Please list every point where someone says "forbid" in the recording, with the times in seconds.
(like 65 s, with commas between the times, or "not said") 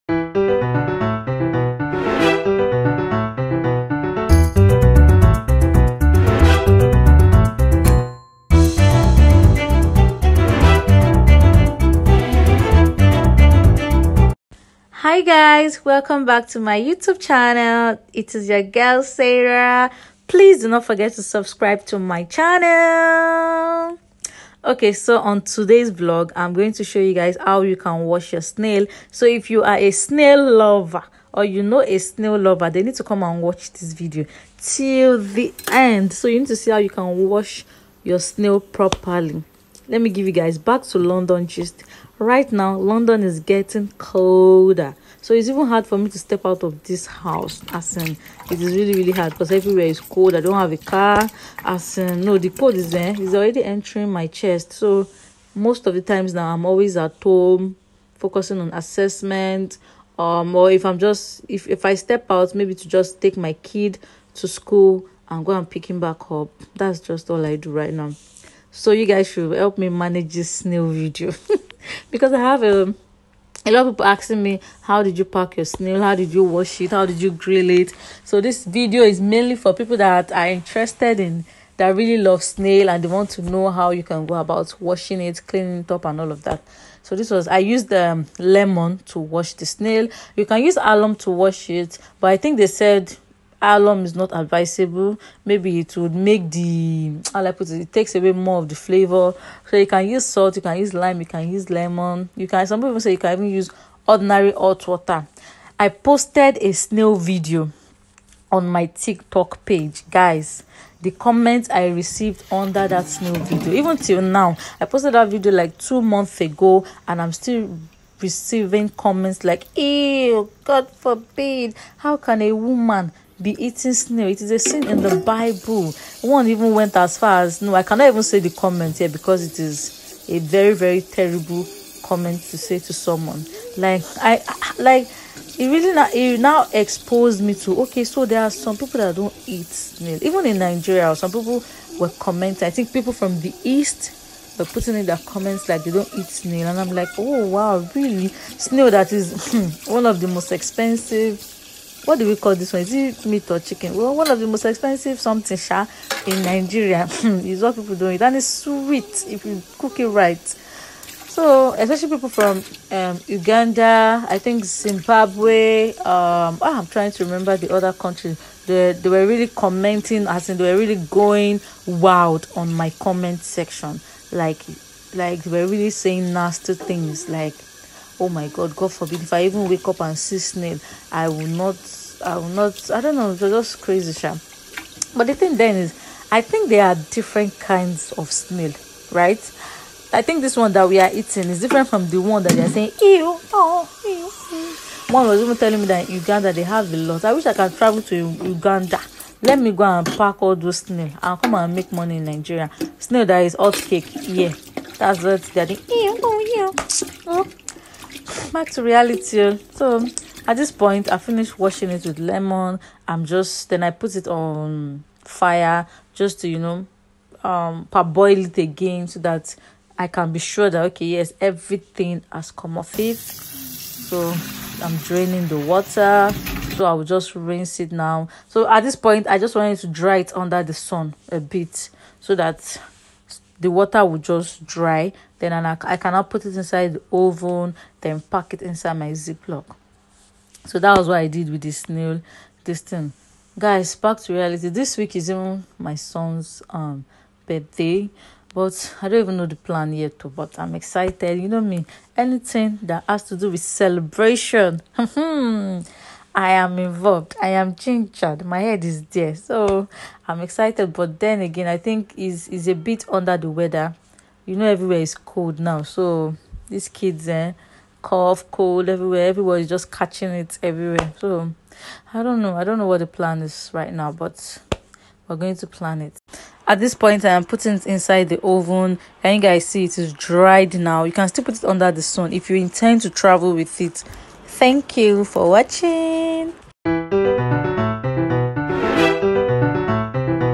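120 s, 178 s.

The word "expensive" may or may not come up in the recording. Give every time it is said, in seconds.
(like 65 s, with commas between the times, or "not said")
150 s, 154 s.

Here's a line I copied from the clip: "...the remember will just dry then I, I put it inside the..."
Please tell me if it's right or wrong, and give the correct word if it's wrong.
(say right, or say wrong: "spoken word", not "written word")
wrong: "water", not "remember".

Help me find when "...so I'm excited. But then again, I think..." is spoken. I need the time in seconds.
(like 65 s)
259 s.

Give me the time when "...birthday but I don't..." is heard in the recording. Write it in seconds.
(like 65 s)
247 s.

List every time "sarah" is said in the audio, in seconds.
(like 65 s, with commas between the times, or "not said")
19 s.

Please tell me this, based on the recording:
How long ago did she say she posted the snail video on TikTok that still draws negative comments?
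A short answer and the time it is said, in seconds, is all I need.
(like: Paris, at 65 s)
2 months ago, at 115 s.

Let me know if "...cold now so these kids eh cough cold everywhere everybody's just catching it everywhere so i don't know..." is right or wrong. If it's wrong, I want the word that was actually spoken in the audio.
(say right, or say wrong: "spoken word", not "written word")
right.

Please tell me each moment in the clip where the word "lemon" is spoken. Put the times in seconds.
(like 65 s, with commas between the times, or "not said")
88 s, 101 s, 212 s.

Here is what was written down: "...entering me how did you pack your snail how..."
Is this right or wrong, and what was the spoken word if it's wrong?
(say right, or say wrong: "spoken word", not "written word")
wrong: "asking", not "entering".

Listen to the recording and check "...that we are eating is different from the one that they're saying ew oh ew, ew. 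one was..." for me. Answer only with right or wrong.
right.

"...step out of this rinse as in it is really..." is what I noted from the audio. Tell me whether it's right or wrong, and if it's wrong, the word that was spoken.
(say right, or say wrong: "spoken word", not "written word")
wrong: "house", not "rinse".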